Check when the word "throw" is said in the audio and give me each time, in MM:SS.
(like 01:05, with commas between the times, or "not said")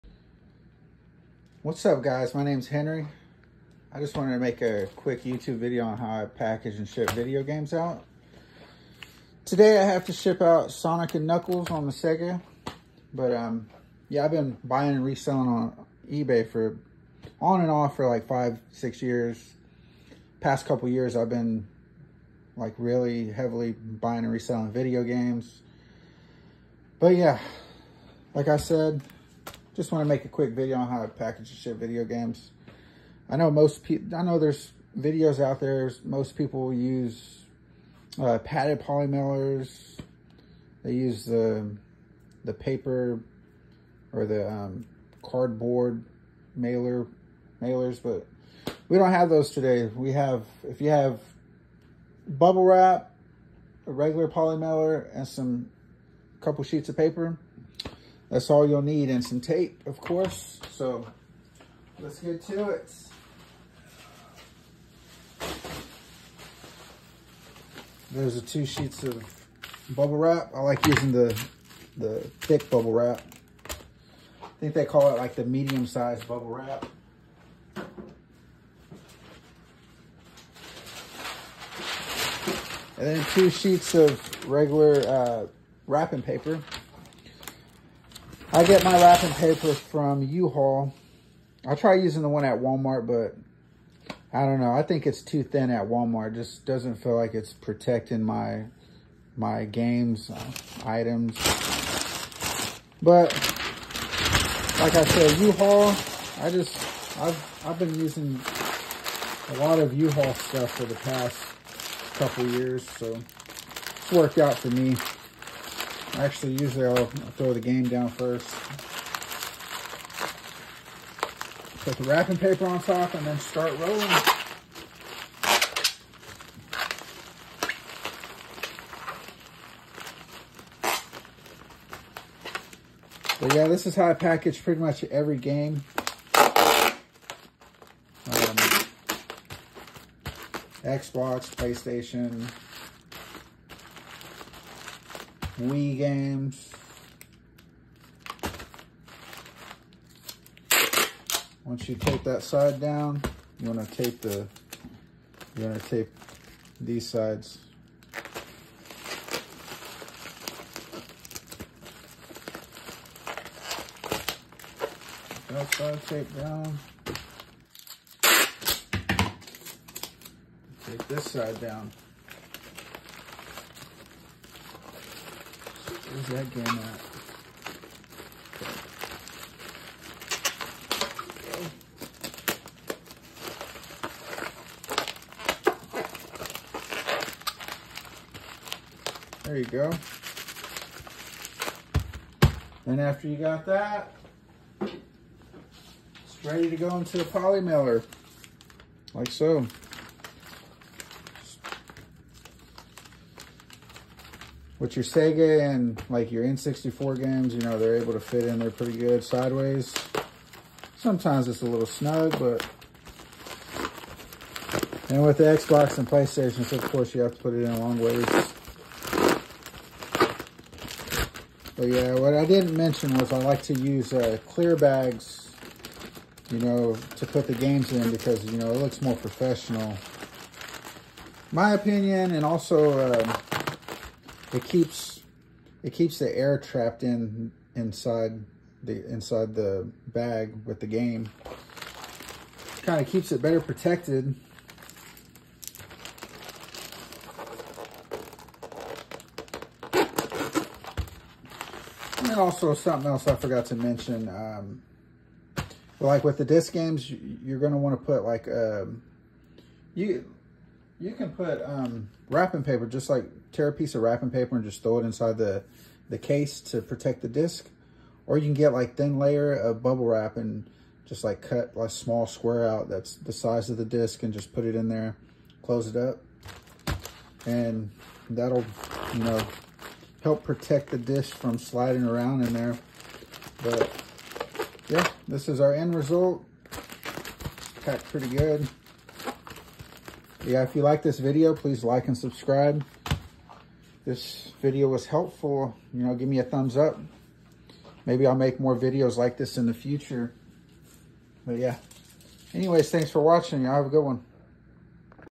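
01:57, 04:24.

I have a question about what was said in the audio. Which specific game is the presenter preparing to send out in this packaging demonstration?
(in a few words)
Sonic and Knuckles.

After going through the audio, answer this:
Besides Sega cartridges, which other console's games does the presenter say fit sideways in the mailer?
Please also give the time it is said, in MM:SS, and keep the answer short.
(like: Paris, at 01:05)
N64, at 03:26.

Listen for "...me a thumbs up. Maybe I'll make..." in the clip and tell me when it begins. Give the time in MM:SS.
04:56.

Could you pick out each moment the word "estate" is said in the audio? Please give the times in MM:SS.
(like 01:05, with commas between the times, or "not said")
not said.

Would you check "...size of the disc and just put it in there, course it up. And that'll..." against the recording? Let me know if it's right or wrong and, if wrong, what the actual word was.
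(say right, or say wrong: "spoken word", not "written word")
wrong: "close", not "course".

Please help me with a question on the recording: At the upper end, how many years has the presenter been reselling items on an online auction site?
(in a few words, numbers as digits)
6.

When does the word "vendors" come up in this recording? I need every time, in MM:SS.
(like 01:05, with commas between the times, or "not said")
not said.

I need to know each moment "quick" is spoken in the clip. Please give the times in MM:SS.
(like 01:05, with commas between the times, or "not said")
00:04, 00:30.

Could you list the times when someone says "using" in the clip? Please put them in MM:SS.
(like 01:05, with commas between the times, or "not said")
01:10, 01:31, 01:47.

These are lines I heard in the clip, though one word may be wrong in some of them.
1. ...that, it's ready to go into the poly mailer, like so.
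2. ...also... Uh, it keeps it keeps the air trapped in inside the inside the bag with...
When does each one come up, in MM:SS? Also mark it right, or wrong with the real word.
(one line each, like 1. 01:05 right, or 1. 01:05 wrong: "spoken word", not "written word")
1. 03:13 right
2. 03:52 right.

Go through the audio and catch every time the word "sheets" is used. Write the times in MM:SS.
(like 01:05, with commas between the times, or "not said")
00:56, 01:08, 01:23.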